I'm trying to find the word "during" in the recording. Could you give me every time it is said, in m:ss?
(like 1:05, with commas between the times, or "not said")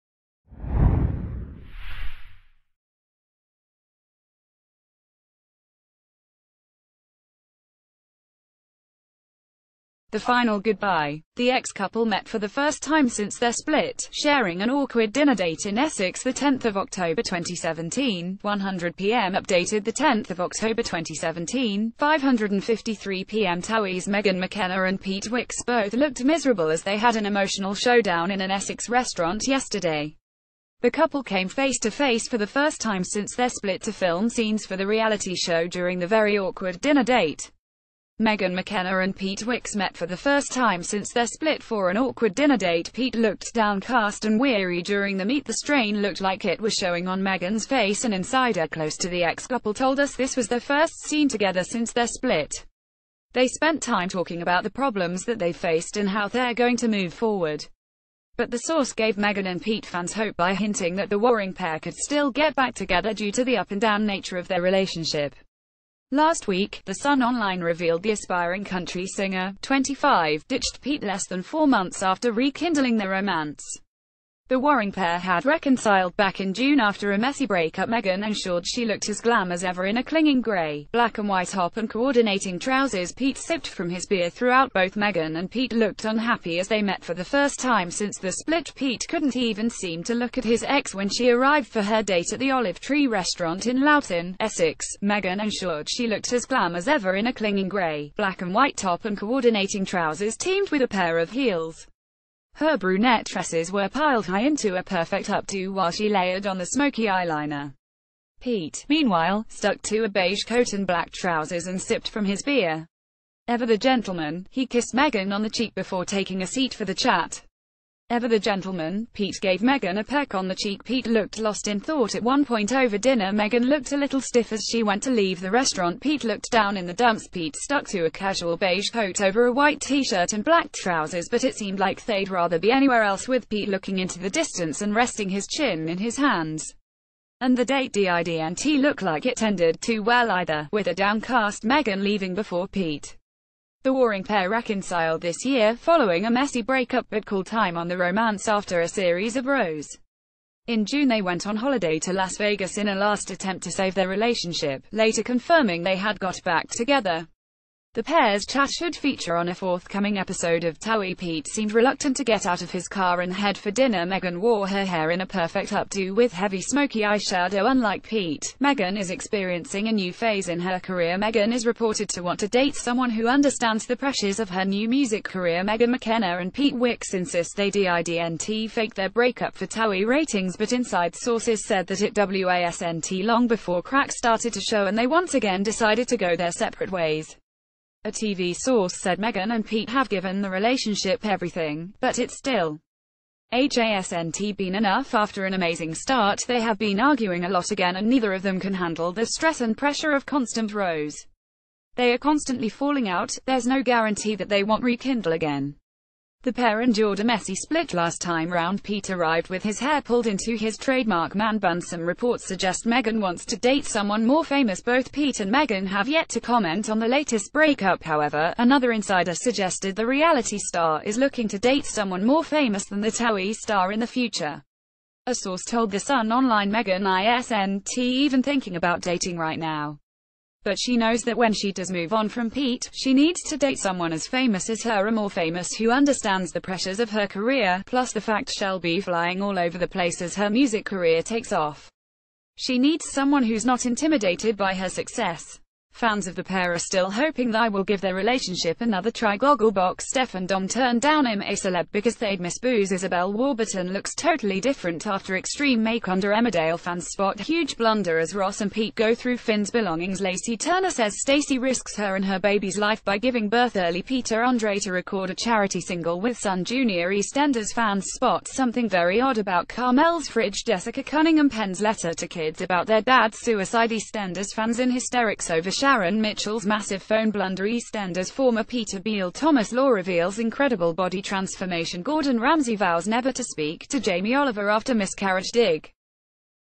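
0:35, 0:44.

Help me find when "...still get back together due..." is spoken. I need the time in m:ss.
1:01.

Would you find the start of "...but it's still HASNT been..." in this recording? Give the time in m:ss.
3:11.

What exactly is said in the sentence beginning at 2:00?
Pete looked lost in thought at one point over dinner.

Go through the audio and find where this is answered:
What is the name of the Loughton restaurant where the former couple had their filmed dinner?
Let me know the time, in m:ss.
1:32.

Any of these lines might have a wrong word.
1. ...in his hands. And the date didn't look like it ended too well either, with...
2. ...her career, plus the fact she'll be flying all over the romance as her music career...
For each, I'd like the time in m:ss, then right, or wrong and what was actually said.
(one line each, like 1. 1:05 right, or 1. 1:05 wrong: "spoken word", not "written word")
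1. 2:15 right
2. 3:57 wrong: "place", not "romance".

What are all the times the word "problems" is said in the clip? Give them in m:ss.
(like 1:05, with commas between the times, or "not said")
0:54.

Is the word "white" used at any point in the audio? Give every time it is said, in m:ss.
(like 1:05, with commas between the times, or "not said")
1:21, 1:38, 2:09.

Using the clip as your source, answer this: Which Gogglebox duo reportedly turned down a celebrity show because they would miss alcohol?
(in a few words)
Steph and Dom.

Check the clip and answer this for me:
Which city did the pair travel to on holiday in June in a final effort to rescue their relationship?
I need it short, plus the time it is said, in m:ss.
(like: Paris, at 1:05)
Las Vegas, at 2:32.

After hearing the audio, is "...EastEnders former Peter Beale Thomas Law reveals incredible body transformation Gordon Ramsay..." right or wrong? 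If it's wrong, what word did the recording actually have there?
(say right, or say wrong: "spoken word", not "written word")
right.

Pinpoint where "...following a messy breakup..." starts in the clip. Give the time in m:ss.
2:25.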